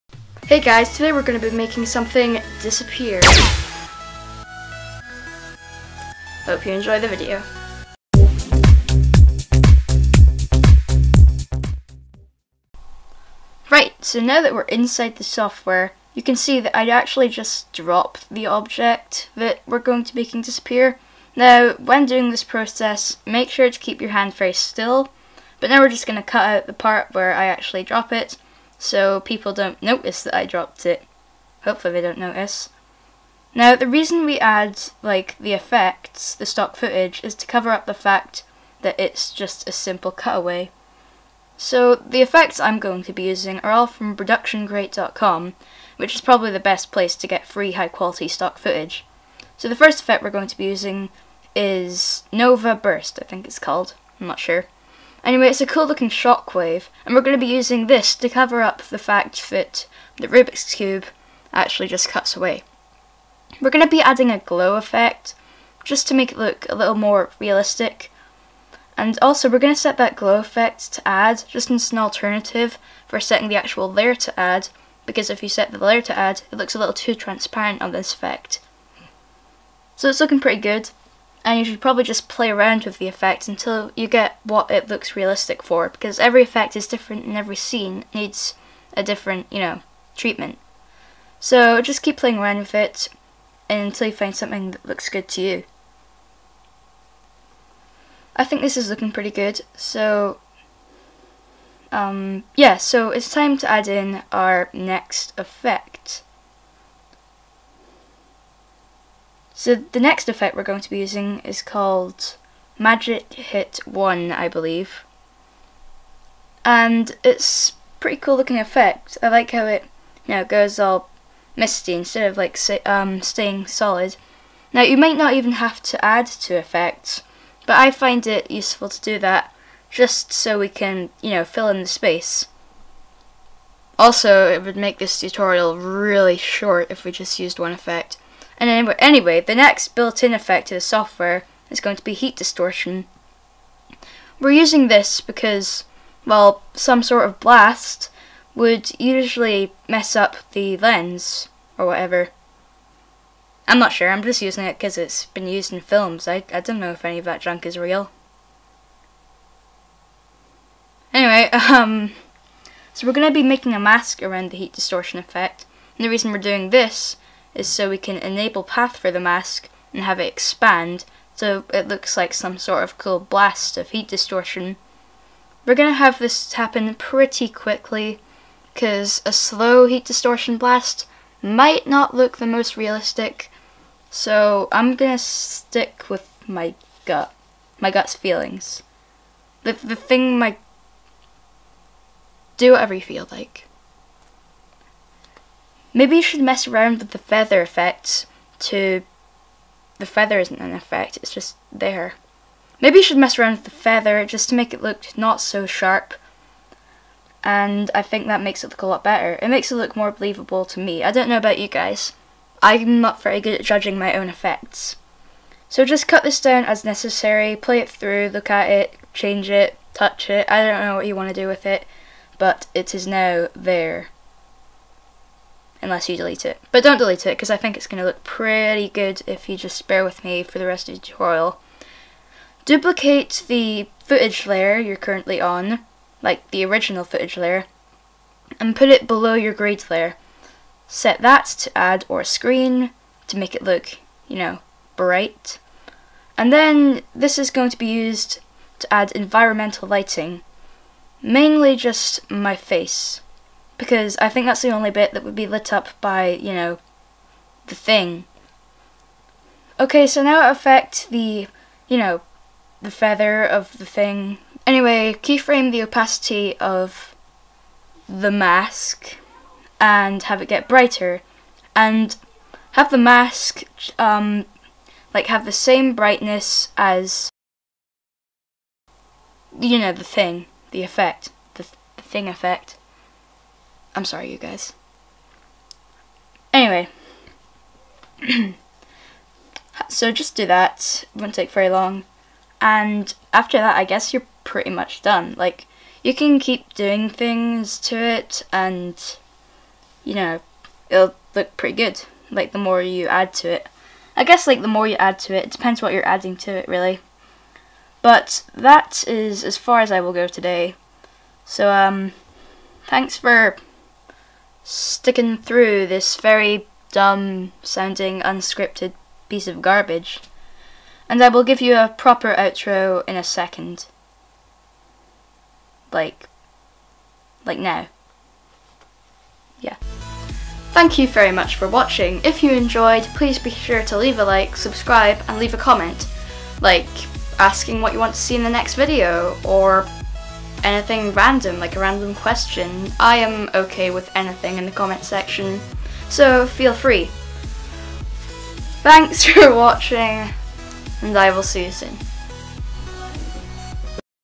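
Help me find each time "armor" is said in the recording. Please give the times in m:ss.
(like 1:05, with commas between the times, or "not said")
not said.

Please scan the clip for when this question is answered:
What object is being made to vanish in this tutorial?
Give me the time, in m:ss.
1:00.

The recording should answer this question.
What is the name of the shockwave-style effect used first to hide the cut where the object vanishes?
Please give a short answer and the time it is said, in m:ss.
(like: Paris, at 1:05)
Nova Burst, at 0:52.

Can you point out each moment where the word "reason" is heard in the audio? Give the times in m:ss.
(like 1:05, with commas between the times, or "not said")
0:33, 2:46.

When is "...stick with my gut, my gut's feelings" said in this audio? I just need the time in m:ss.
3:05.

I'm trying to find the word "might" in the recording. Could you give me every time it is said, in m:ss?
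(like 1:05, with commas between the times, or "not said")
2:04, 3:01.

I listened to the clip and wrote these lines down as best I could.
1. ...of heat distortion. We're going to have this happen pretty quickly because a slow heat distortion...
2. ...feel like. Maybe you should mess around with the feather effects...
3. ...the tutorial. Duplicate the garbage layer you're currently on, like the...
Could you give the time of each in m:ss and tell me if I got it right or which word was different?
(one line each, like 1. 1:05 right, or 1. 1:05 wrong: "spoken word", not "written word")
1. 2:53 right
2. 3:13 right
3. 3:50 wrong: "footage", not "garbage".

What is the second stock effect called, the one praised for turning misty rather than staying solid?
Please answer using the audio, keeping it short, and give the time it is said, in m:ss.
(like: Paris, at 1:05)
Magic Hit 1, at 1:52.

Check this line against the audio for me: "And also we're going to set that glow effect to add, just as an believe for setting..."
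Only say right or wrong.
wrong.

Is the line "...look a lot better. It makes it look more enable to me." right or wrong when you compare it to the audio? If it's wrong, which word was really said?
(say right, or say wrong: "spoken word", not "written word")
wrong: "believable", not "enable".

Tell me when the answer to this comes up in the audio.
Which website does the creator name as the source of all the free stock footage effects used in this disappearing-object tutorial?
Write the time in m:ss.
0:44.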